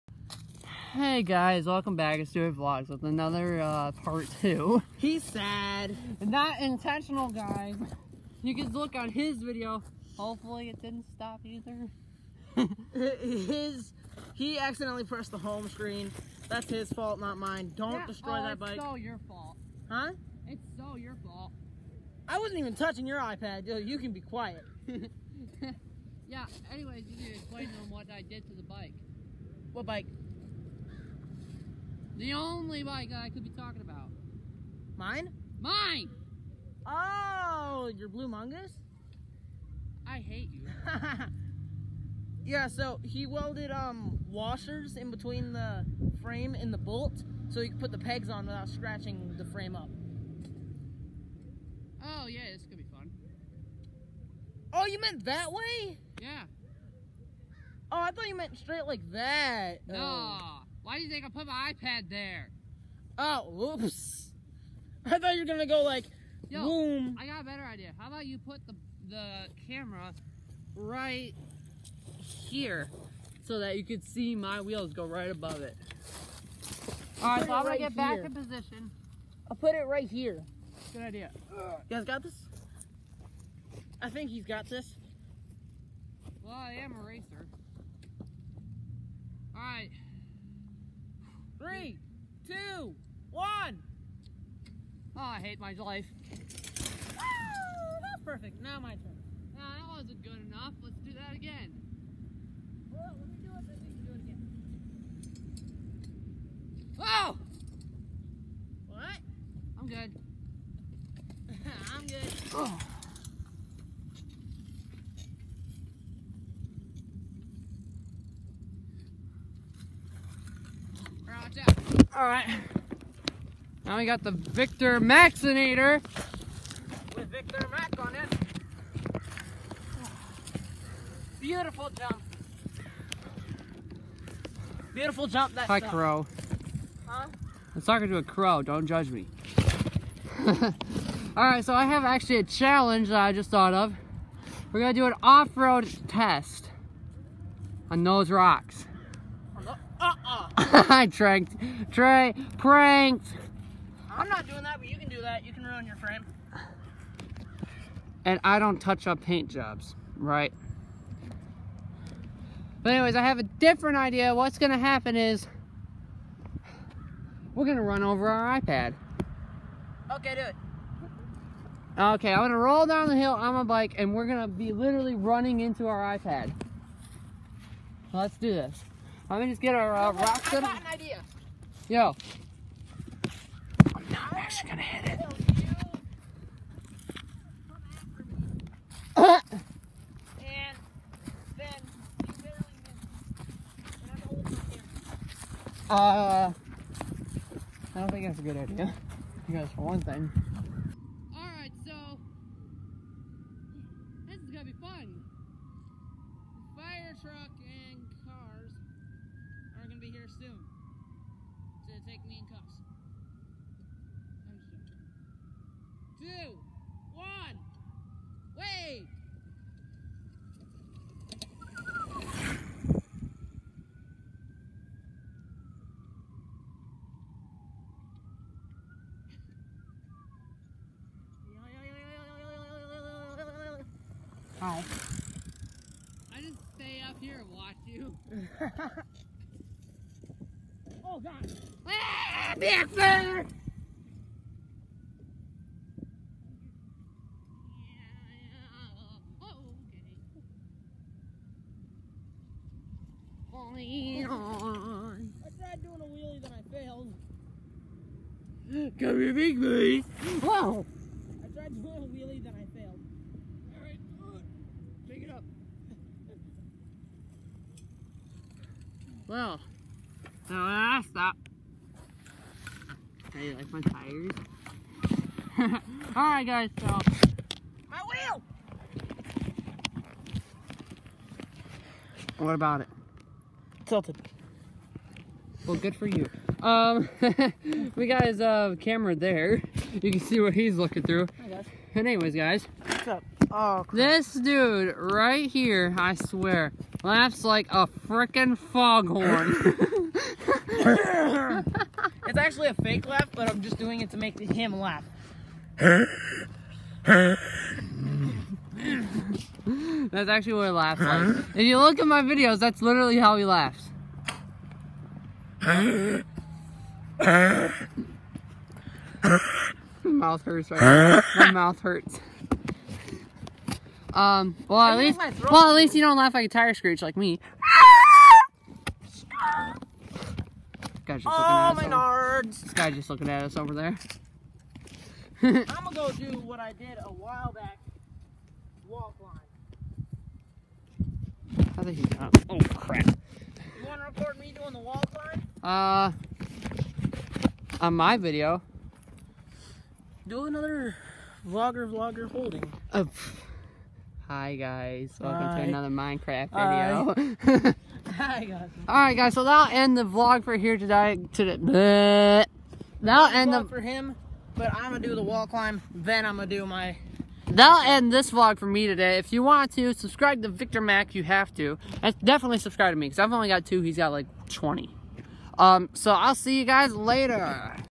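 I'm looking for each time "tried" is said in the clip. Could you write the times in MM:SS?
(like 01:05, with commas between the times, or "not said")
04:02, 04:21.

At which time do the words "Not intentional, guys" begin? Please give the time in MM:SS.
00:06.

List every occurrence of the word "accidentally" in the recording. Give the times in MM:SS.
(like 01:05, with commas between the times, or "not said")
00:14.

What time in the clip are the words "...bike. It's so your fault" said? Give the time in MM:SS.
00:18.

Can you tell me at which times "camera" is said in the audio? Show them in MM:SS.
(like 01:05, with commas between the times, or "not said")
01:09, 04:48.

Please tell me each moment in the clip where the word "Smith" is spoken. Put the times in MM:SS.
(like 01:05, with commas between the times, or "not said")
not said.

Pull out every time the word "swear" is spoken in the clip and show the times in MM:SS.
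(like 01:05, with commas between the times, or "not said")
04:56.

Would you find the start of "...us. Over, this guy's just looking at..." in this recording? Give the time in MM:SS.
05:31.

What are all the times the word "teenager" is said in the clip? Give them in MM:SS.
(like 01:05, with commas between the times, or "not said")
not said.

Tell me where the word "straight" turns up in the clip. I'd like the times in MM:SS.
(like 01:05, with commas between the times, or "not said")
00:58.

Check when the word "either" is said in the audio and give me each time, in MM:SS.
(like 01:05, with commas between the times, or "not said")
00:11.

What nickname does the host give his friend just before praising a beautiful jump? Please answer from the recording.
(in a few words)
Victor Maxinator.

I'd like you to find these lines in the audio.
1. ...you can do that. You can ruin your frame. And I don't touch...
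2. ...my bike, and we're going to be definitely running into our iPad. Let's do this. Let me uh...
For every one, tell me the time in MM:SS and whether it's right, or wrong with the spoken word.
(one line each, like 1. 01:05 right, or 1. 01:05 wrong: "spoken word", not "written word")
1. 02:34 right
2. 02:53 wrong: "literally", not "definitely".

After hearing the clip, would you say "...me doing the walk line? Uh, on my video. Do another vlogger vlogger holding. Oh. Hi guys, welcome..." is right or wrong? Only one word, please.
right.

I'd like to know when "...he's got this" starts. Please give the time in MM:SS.
01:24.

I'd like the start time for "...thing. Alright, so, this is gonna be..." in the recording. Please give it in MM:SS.
03:20.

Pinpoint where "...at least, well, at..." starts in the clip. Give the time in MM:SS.
05:24.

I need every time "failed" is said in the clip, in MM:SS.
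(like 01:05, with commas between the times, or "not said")
04:16, 04:22.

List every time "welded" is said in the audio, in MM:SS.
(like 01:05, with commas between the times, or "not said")
00:43.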